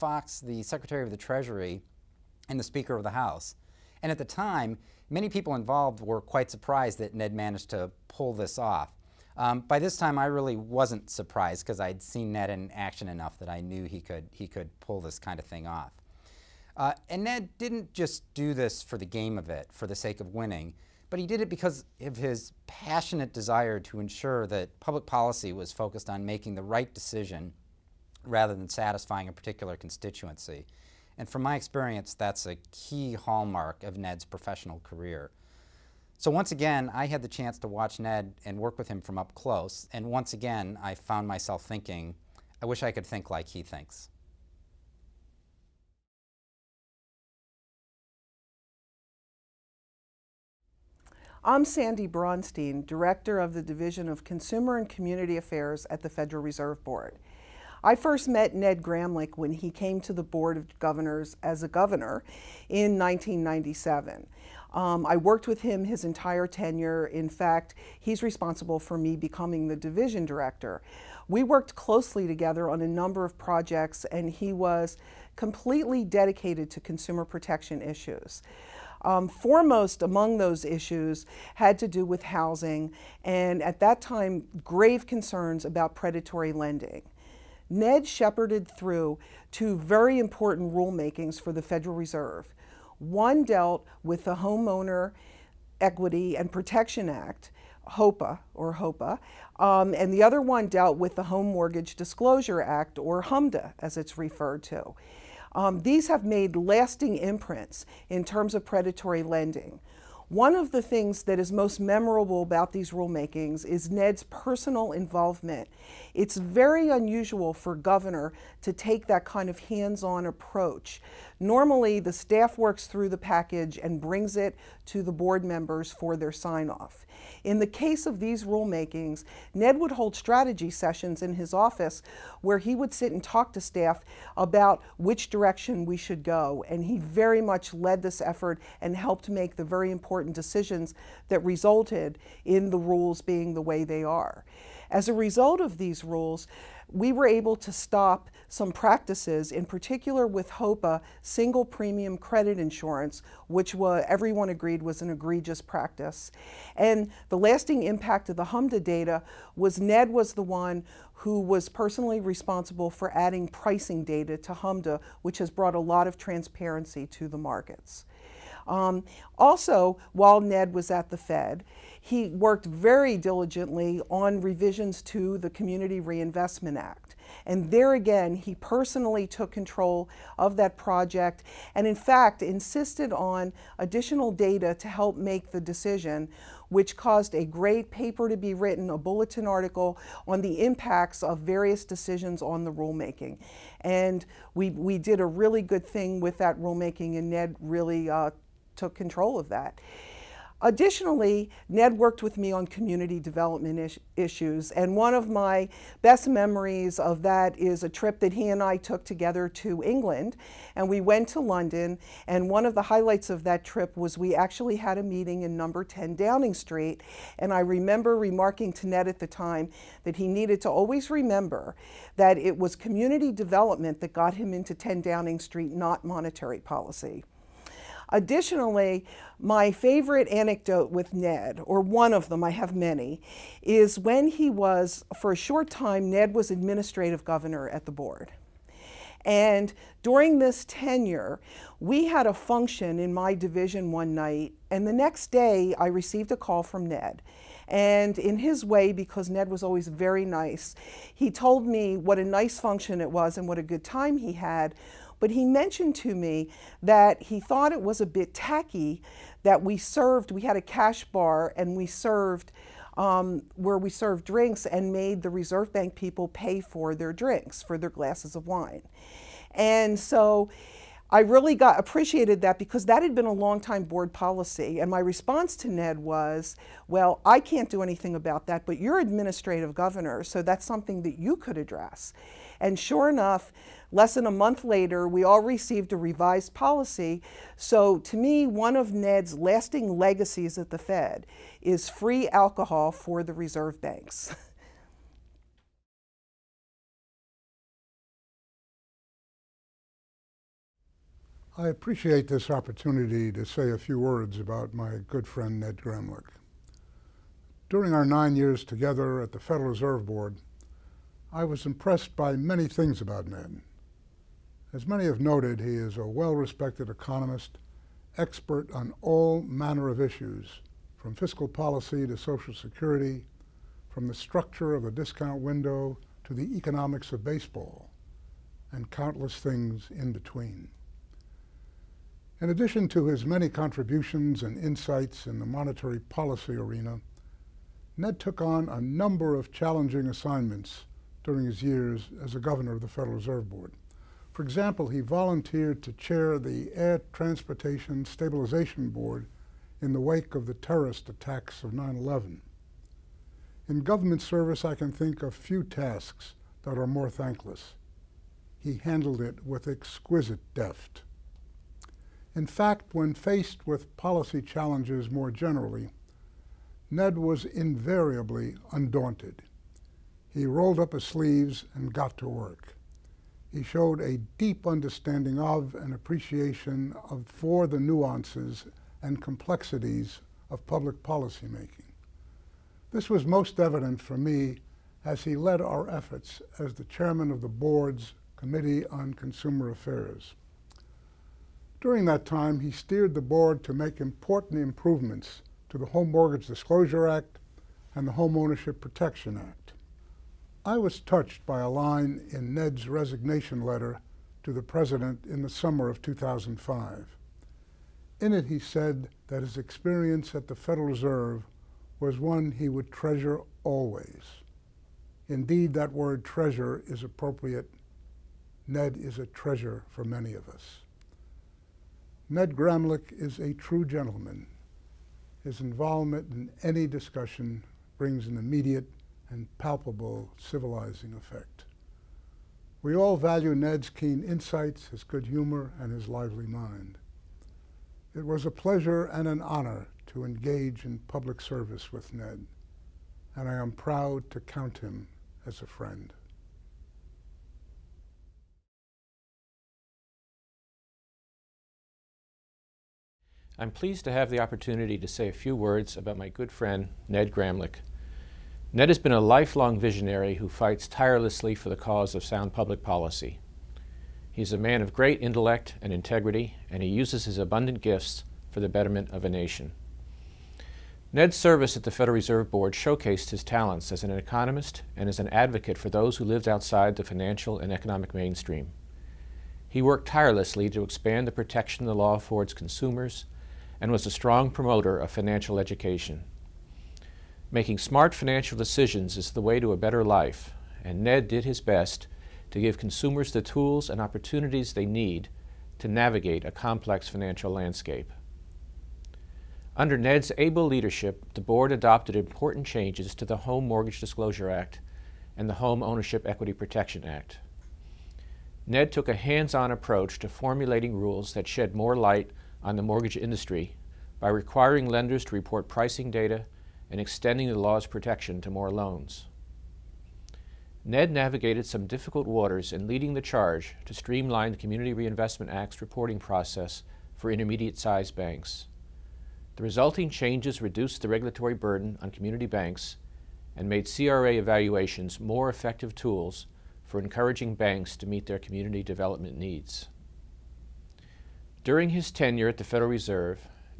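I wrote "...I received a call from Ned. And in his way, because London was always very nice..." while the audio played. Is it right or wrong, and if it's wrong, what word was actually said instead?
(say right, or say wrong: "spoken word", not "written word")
wrong: "Ned", not "London".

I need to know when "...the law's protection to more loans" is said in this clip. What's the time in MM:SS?
08:37.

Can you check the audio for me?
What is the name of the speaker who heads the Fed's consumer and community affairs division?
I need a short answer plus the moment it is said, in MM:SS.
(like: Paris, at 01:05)
Sandy Braunstein, at 00:51.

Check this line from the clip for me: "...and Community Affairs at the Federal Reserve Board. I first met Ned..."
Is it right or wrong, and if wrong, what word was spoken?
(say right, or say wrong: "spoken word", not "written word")
right.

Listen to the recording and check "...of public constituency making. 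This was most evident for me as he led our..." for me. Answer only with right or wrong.
wrong.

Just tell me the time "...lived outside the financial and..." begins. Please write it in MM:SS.
07:56.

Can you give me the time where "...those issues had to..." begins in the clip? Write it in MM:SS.
01:20.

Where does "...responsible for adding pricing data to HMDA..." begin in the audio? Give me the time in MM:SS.
02:42.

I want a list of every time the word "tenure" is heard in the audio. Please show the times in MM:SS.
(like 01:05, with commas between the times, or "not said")
01:06, 04:00, 09:02.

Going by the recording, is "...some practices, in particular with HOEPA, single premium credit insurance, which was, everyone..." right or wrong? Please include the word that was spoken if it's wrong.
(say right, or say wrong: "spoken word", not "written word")
right.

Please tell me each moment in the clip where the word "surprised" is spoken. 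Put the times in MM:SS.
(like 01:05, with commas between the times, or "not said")
00:06, 00:11.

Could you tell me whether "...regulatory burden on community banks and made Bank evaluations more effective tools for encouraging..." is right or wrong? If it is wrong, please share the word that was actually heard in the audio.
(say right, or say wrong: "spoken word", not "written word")
wrong: "CRA", not "Bank".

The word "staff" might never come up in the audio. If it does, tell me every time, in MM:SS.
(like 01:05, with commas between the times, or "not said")
02:02, 02:13.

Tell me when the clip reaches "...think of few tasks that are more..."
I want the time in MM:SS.
05:54.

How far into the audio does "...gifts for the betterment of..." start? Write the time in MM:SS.
07:47.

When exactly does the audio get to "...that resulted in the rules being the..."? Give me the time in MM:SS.
02:21.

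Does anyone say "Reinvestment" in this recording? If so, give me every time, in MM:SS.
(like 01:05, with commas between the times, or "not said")
02:55, 08:44.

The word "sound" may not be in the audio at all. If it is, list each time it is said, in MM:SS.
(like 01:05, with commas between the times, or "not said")
07:42.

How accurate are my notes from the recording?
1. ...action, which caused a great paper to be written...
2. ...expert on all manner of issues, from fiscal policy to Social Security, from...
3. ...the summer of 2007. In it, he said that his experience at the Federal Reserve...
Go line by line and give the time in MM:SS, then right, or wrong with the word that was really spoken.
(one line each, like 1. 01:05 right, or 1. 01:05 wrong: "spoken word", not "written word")
1. 03:05 wrong: "decision", not "action"
2. 05:18 right
3. 06:45 wrong: "2005", not "2007".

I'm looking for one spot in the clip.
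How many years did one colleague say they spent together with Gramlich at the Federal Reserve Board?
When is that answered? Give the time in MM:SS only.
05:08.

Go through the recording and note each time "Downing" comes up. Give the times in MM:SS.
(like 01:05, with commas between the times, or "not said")
03:36, 03:45.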